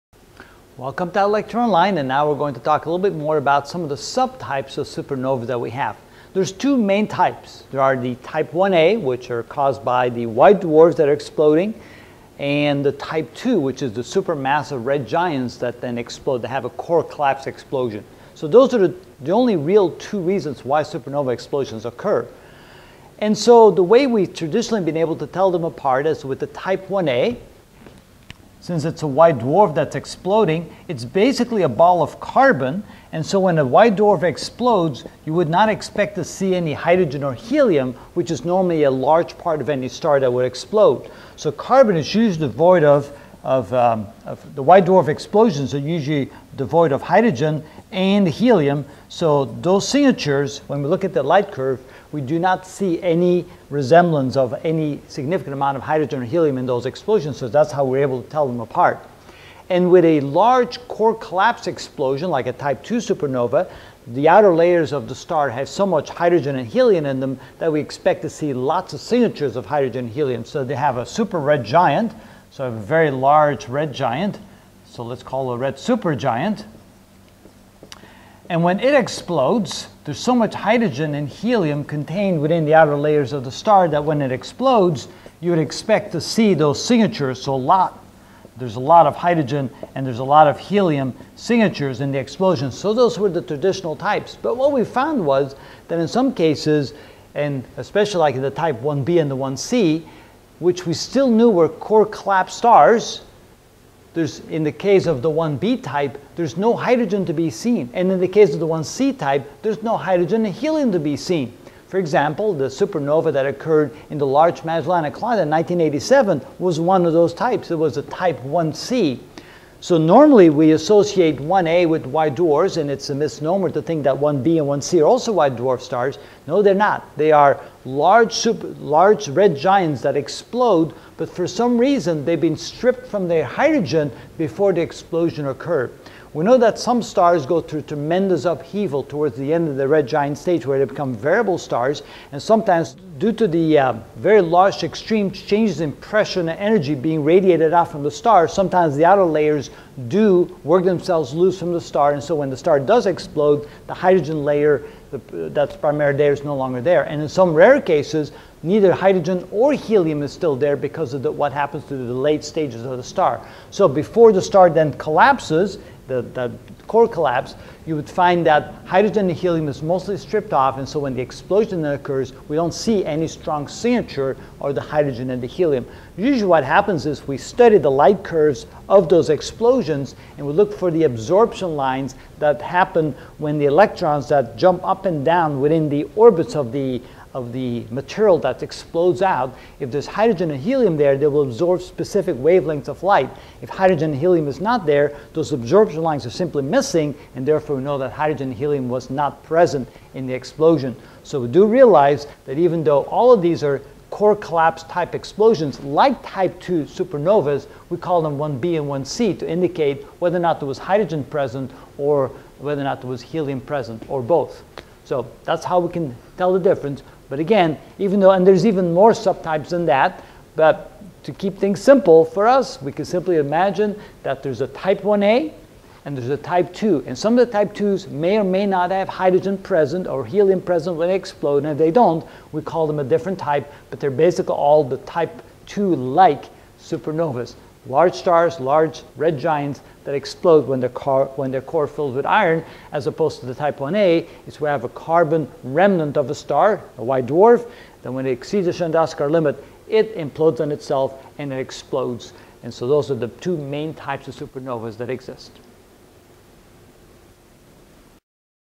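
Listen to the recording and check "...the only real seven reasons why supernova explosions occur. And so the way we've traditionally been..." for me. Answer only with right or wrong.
wrong.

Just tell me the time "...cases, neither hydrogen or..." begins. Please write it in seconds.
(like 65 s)
157 s.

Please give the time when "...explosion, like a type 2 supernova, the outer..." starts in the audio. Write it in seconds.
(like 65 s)
61 s.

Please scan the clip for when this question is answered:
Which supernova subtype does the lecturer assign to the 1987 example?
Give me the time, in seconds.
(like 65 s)
118 s.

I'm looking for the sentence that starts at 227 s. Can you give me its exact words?
And some of the type 2s may or may not have hydrogen present or helium present when they explode.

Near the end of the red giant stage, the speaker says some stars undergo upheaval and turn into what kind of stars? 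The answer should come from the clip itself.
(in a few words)
Variable stars.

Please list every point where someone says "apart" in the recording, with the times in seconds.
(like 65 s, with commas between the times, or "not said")
25 s, 58 s.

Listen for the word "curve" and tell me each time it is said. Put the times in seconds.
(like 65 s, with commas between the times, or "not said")
51 s, 178 s.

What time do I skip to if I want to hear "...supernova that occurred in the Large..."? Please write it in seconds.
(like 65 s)
112 s.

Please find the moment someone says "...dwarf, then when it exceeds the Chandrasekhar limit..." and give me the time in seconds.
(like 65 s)
247 s.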